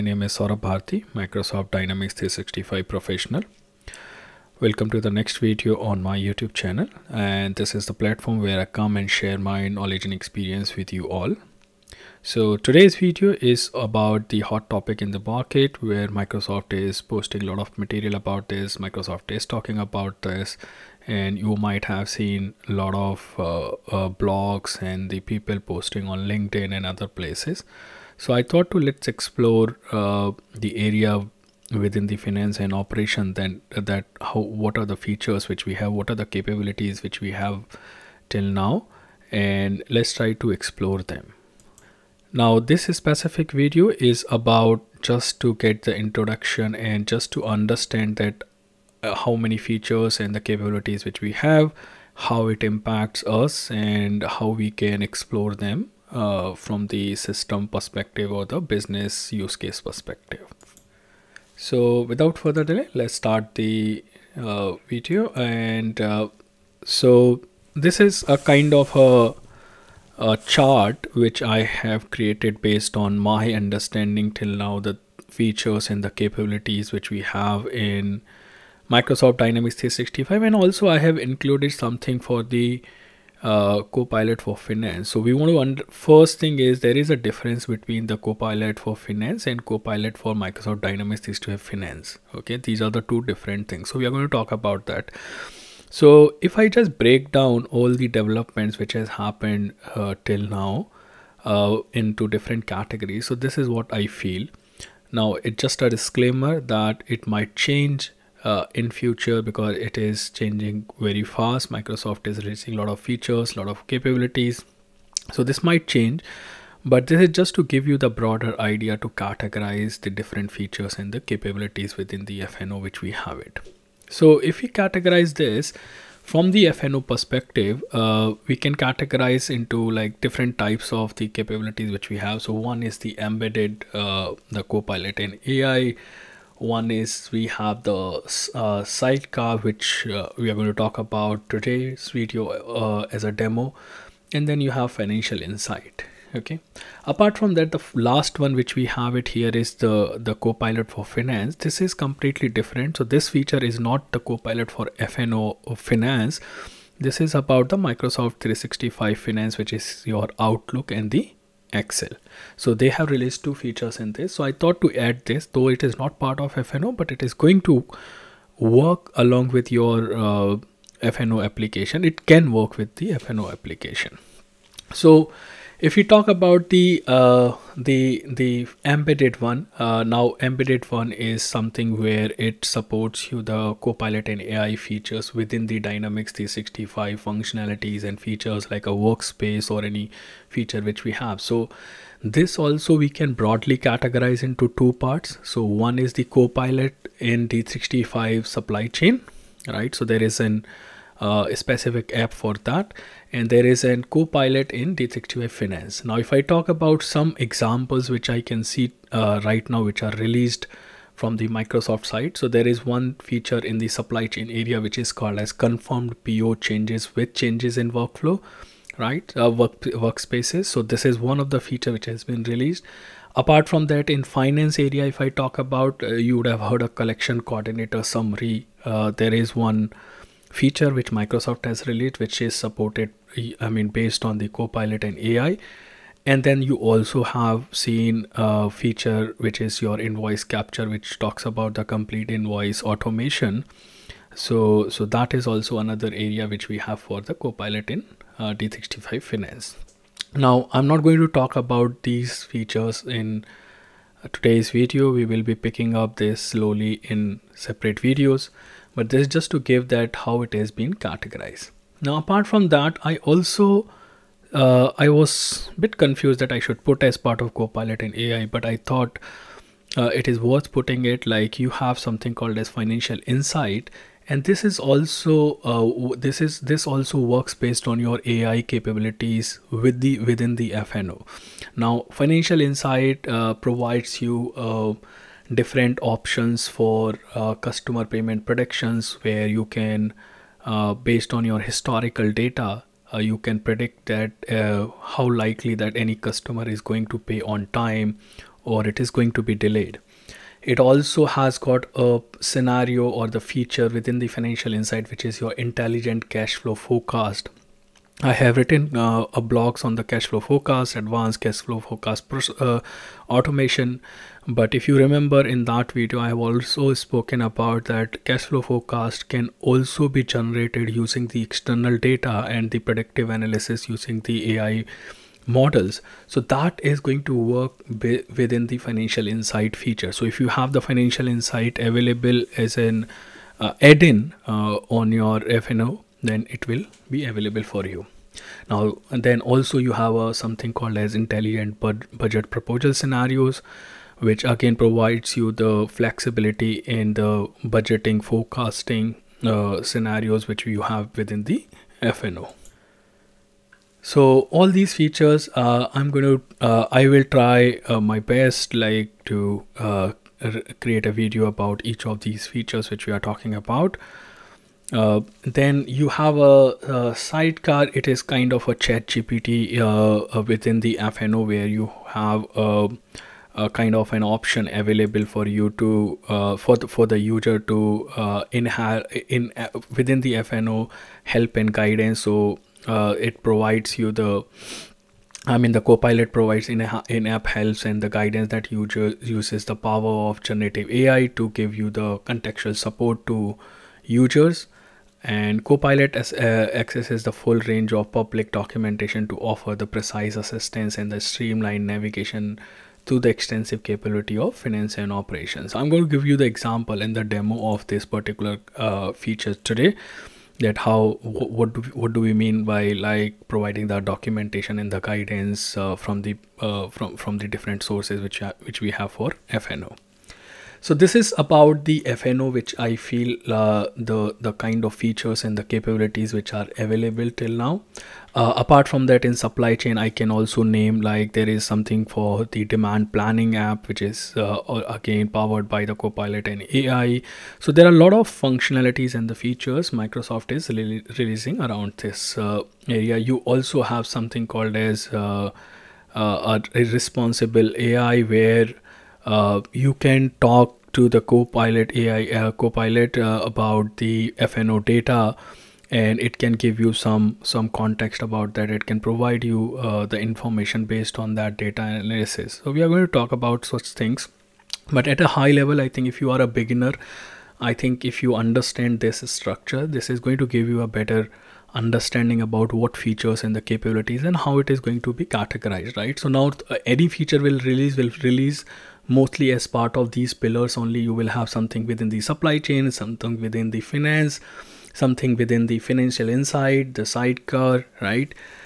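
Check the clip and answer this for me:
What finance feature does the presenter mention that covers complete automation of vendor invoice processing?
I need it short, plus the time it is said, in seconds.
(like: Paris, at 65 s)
Invoice capture, at 239 s.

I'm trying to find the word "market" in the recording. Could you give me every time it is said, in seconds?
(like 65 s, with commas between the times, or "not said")
15 s.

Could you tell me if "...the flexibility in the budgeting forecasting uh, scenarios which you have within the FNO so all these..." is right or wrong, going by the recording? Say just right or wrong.
right.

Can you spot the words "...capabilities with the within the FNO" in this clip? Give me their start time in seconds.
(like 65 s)
278 s.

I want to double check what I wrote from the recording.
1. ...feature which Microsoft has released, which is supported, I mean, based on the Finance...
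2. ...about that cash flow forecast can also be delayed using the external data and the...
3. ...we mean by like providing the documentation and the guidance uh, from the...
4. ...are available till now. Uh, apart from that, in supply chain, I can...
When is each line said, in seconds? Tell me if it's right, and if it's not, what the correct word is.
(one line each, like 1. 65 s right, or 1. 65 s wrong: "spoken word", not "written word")
1. 230 s wrong: "Copilot", not "Finance"
2. 317 s wrong: "generated", not "delayed"
3. 412 s right
4. 426 s right.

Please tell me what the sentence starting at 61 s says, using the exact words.
So without further delay, let's start the uh, video.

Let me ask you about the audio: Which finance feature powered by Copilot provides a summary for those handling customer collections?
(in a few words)
Collection coordinator summary.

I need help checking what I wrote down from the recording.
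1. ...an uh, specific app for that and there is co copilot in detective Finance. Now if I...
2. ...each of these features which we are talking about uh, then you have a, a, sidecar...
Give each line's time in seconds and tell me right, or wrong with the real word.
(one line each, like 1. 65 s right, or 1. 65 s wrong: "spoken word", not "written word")
1. 200 s right
2. 361 s right.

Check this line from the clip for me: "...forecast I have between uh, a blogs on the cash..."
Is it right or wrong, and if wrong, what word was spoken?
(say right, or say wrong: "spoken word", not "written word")
wrong: "written", not "between".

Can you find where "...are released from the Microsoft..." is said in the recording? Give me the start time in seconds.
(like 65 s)
210 s.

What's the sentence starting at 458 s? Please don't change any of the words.
It can provide you uh, the information based on that data analysis.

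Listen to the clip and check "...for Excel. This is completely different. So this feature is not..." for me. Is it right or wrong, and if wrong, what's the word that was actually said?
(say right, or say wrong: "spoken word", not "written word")
wrong: "Finance", not "Excel".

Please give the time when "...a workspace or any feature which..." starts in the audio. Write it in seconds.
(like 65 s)
188 s.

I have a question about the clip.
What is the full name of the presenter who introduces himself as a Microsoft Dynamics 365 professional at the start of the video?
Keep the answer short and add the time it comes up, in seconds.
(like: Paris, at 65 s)
Saurabh Bharati, at 0 s.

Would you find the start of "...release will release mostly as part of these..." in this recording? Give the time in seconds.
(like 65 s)
477 s.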